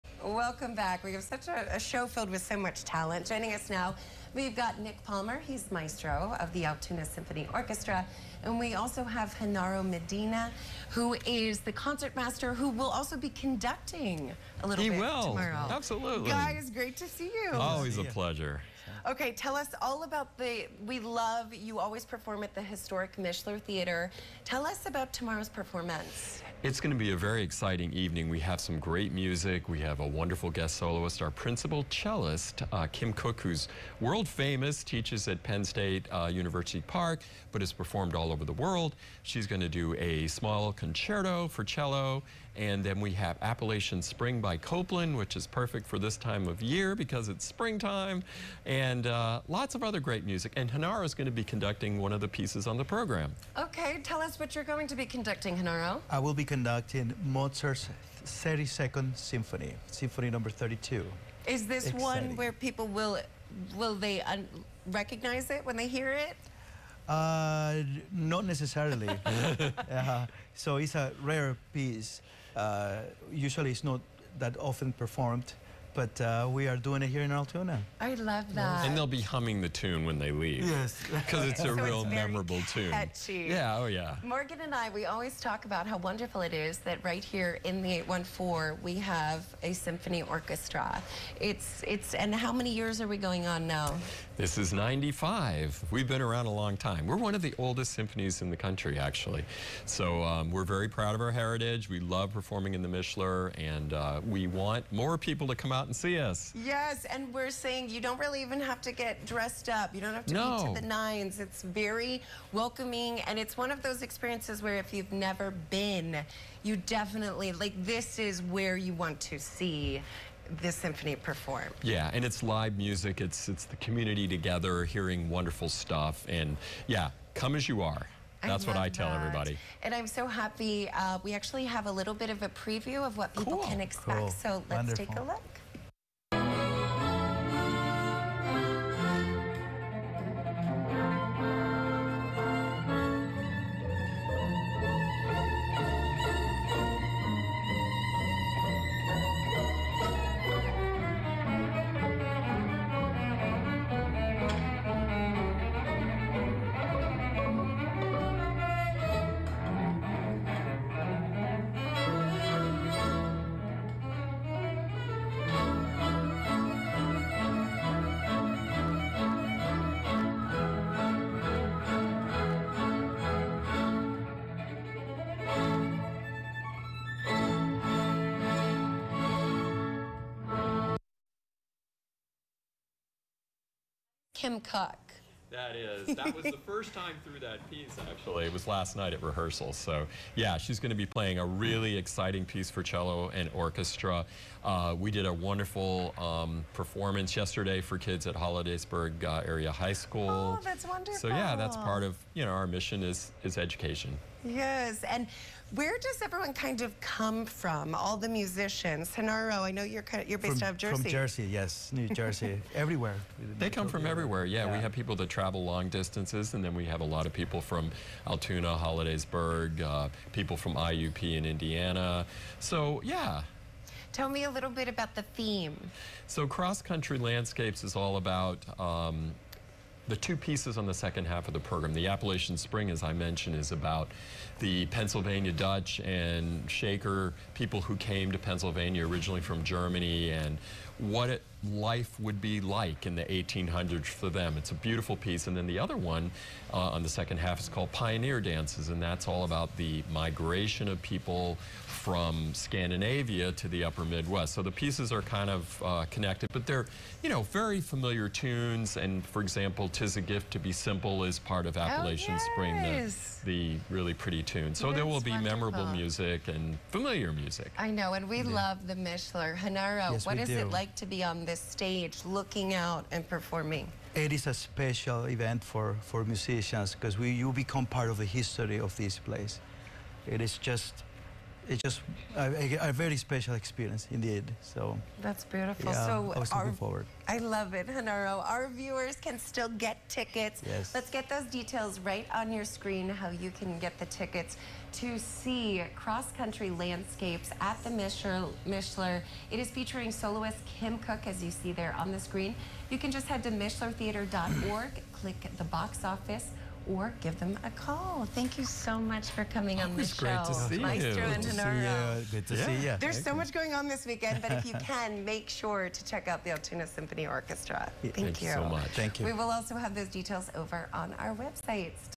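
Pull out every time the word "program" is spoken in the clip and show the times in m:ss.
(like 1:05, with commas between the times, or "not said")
0:52, 3:51.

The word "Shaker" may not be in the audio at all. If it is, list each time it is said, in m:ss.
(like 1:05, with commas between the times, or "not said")
3:56.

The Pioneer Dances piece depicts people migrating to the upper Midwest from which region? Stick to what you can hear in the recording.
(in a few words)
Scandinavia.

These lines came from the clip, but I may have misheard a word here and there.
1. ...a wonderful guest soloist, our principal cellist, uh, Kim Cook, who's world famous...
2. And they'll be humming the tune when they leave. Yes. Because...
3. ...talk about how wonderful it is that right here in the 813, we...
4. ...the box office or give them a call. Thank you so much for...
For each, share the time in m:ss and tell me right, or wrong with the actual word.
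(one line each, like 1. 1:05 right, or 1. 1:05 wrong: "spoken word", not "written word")
1. 0:30 right
2. 1:18 right
3. 1:25 wrong: "814", not "813"
4. 5:05 right.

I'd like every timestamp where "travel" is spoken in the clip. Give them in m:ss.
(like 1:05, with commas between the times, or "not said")
3:35.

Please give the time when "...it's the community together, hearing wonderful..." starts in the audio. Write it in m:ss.
2:03.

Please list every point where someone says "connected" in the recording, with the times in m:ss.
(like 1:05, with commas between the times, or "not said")
4:16.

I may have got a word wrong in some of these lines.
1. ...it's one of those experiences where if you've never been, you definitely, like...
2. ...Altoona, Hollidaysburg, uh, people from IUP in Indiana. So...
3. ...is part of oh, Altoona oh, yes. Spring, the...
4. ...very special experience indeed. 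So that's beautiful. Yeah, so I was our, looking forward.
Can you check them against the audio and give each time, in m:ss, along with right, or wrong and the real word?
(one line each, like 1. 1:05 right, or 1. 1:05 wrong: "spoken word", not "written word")
1. 1:53 right
2. 3:38 right
3. 4:21 wrong: "Appalachian", not "Altoona"
4. 4:42 right.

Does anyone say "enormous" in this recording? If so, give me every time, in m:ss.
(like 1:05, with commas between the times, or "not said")
not said.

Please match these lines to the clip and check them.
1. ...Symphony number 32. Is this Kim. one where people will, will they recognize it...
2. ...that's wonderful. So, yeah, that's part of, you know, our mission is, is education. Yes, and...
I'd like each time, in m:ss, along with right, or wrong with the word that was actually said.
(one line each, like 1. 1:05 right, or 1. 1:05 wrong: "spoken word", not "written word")
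1. 0:59 wrong: "Exciting", not "Kim"
2. 3:20 right.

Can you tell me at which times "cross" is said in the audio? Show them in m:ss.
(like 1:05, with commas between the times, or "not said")
3:46, 4:55.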